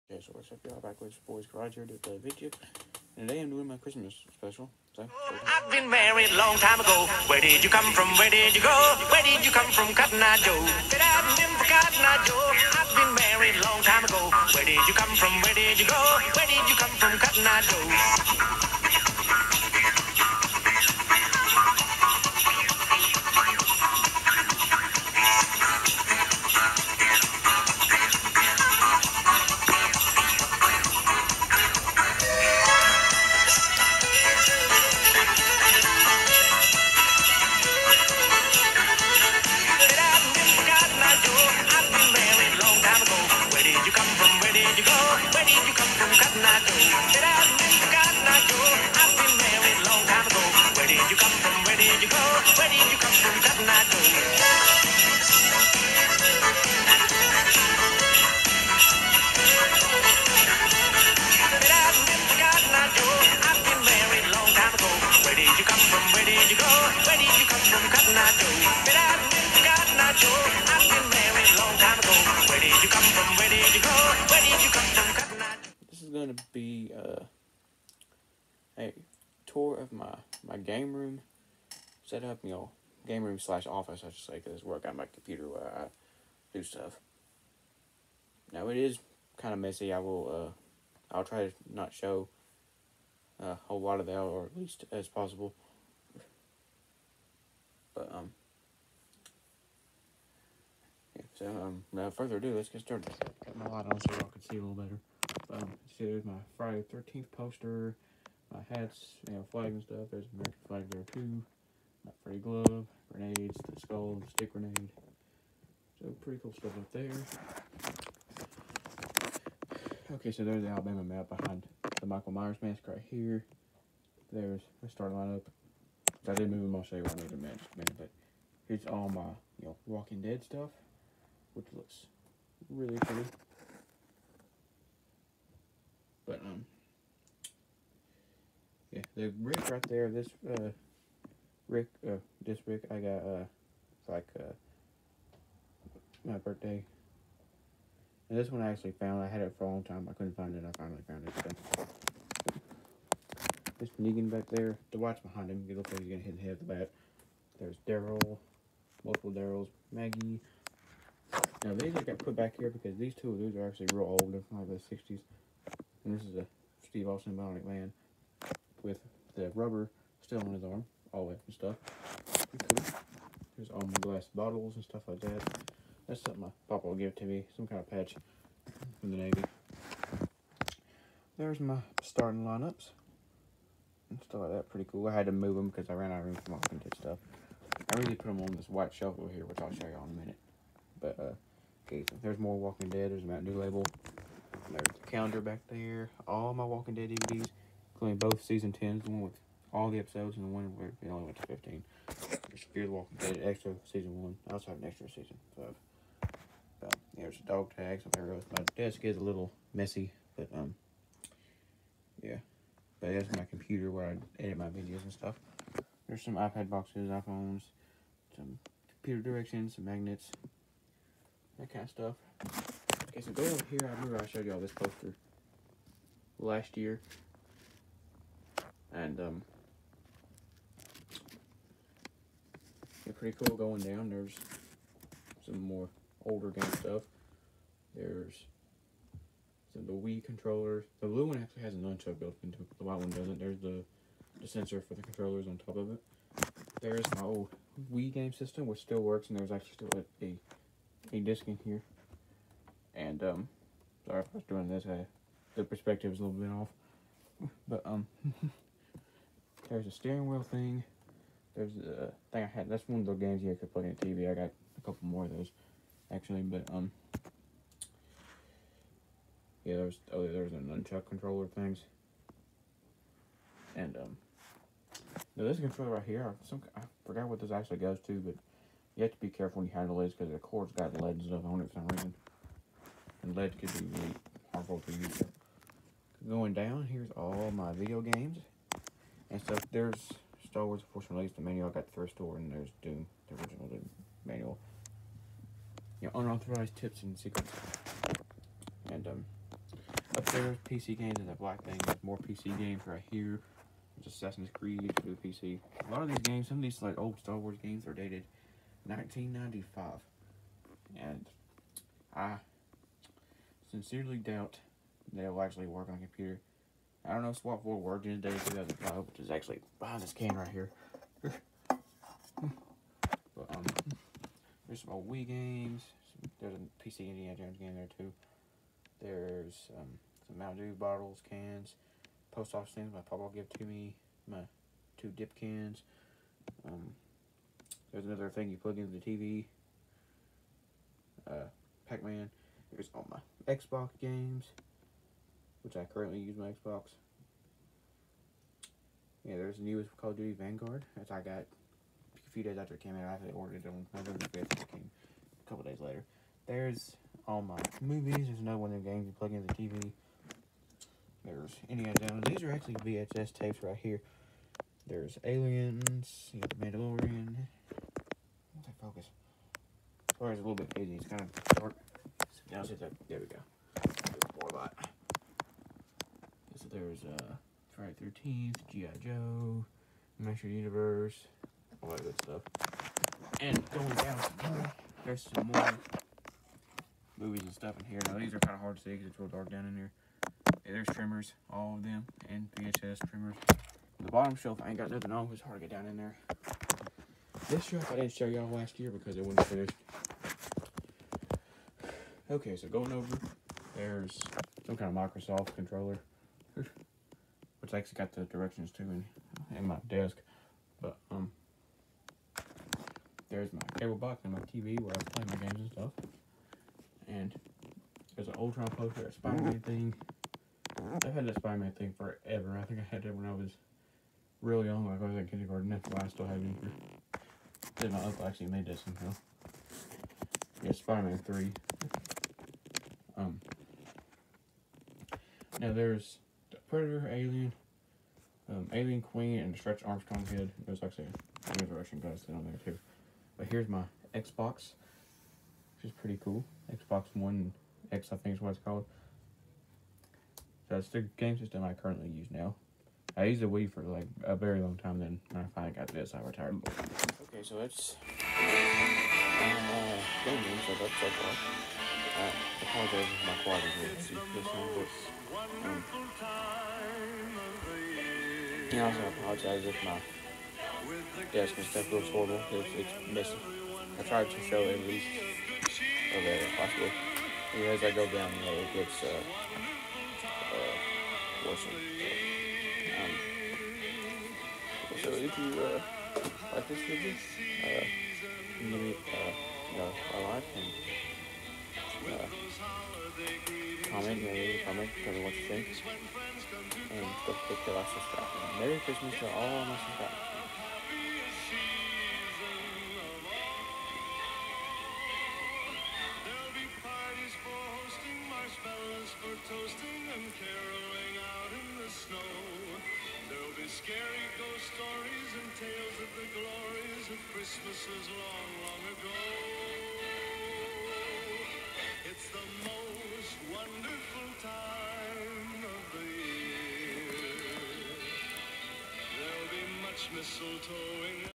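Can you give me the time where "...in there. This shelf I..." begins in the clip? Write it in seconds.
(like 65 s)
395 s.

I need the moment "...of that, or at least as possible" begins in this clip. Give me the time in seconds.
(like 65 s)
94 s.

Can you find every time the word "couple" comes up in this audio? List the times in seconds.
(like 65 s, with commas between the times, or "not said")
264 s, 355 s.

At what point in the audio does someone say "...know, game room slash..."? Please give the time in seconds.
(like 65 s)
82 s.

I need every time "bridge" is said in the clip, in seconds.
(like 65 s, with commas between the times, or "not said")
139 s.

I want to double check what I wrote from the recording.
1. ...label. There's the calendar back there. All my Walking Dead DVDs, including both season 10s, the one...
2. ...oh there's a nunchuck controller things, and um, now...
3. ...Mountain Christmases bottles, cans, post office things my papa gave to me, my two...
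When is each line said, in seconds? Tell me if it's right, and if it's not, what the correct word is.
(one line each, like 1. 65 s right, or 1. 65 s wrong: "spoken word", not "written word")
1. 193 s right
2. 270 s right
3. 330 s wrong: "Dew", not "Christmases".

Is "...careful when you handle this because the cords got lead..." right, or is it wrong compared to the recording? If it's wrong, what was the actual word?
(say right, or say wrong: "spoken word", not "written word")
right.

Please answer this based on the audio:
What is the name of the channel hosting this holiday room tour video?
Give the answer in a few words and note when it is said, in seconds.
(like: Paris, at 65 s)
Backwoods Boys Garage, at 0 s.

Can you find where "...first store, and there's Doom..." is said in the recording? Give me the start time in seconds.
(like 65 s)
291 s.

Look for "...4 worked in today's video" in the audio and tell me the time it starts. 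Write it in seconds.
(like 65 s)
317 s.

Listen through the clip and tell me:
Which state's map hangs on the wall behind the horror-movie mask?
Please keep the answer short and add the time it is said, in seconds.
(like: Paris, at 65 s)
Alabama, at 120 s.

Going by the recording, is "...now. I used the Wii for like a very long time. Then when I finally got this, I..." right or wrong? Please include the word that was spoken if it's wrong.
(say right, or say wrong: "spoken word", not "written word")
right.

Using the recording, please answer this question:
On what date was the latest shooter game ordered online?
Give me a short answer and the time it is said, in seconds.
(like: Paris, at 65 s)
November 5th, at 353 s.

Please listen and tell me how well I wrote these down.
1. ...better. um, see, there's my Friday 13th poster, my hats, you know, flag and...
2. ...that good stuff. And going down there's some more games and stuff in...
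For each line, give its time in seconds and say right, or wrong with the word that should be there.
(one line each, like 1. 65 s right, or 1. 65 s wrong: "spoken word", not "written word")
1. 104 s right
2. 381 s wrong: "movies", not "games".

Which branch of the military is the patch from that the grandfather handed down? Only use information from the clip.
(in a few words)
Navy.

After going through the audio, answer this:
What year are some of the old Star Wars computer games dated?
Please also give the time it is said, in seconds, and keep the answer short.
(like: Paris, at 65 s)
1995, at 308 s.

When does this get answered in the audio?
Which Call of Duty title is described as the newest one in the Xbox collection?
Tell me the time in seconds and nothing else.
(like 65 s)
350 s.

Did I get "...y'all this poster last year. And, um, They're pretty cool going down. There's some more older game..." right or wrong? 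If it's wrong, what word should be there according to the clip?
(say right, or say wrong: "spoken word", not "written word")
right.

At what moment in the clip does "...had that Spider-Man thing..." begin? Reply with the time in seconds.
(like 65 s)
421 s.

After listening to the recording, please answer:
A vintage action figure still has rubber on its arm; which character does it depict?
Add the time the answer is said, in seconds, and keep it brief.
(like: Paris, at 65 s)
Steve Austin, at 166 s.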